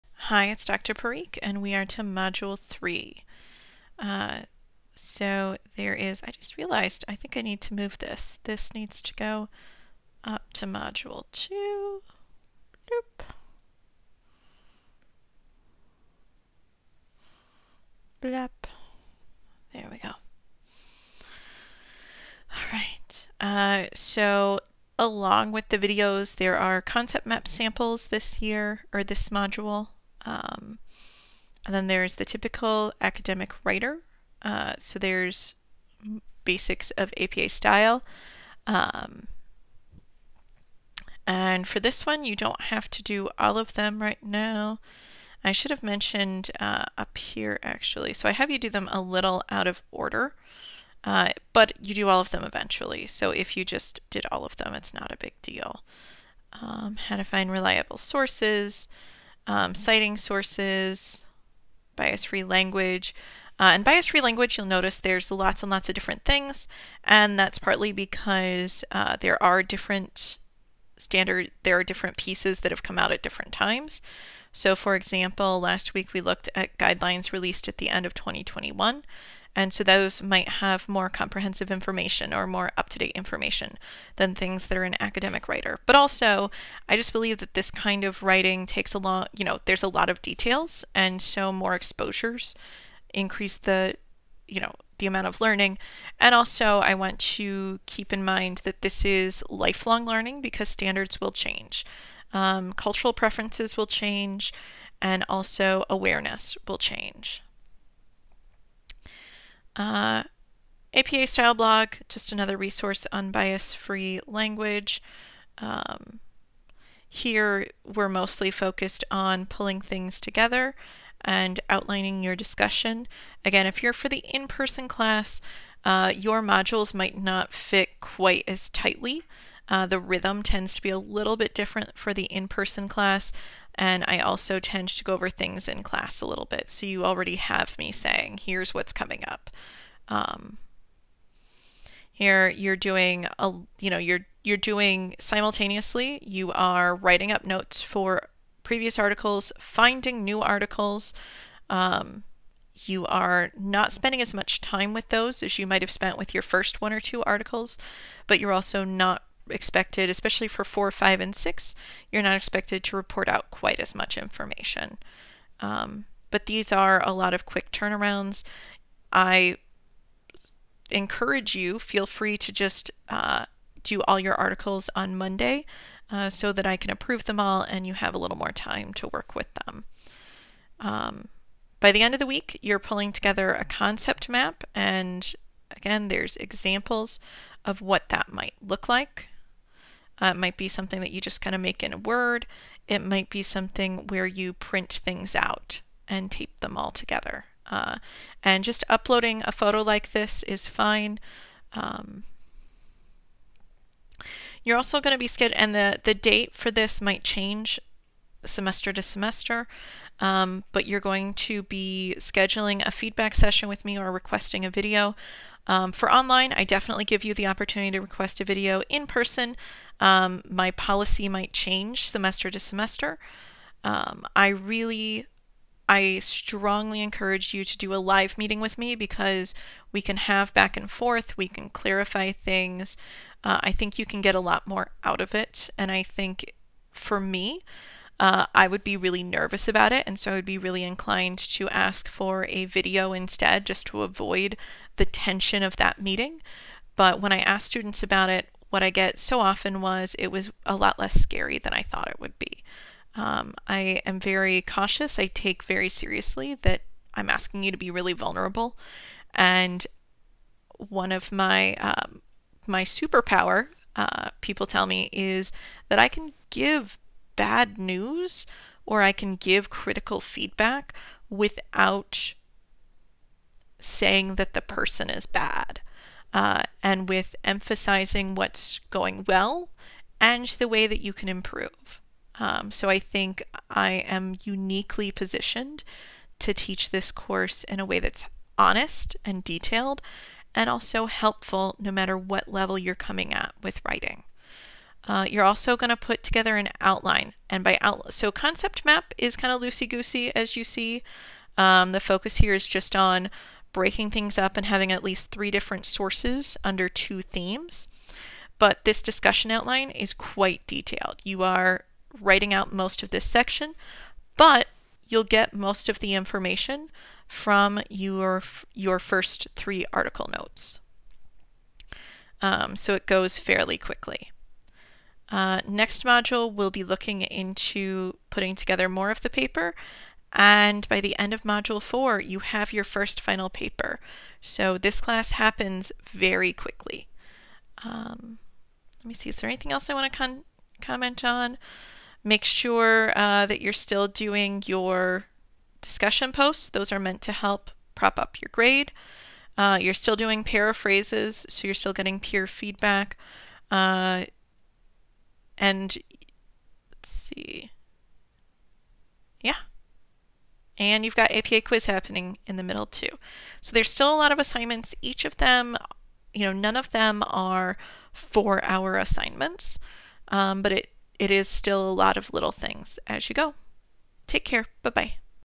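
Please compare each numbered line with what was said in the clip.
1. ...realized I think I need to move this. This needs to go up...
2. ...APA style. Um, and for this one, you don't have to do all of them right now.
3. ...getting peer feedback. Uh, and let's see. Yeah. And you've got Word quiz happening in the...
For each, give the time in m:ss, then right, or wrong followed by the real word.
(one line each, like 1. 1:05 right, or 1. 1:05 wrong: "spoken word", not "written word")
1. 0:06 right
2. 0:37 right
3. 5:51 wrong: "APA", not "Word".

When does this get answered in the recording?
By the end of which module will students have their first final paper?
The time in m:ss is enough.
5:31.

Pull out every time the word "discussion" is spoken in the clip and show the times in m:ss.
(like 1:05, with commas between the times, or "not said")
2:02, 5:09, 5:45.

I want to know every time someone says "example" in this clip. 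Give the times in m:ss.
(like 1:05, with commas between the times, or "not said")
1:14, 3:06.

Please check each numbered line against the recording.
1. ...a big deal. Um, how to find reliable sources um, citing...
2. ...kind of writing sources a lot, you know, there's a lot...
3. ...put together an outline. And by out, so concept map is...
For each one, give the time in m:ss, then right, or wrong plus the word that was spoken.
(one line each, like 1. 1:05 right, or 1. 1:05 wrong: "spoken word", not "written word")
1. 0:55 right
2. 1:27 wrong: "takes", not "sources"
3. 4:55 right.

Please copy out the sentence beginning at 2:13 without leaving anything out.
And I also tend to go over things in class a little bit.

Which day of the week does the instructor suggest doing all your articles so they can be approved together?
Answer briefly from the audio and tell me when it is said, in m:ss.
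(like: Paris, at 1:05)
Monday, at 2:55.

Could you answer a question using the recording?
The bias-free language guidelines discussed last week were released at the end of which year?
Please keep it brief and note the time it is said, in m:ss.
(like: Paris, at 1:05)
2021, at 1:18.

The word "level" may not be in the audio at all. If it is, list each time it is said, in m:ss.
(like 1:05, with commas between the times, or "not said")
4:52.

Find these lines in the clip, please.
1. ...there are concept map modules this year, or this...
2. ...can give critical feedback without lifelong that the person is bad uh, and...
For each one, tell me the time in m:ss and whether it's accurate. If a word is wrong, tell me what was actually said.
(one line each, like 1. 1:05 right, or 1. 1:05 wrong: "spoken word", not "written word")
1. 0:26 wrong: "samples", not "modules"
2. 4:29 wrong: "saying", not "lifelong".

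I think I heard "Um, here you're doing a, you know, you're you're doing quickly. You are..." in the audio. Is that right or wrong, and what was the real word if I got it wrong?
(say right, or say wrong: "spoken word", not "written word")
wrong: "simultaneously", not "quickly".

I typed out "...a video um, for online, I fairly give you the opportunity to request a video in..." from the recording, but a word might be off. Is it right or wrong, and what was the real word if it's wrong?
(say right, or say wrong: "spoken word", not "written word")
wrong: "definitely", not "fairly".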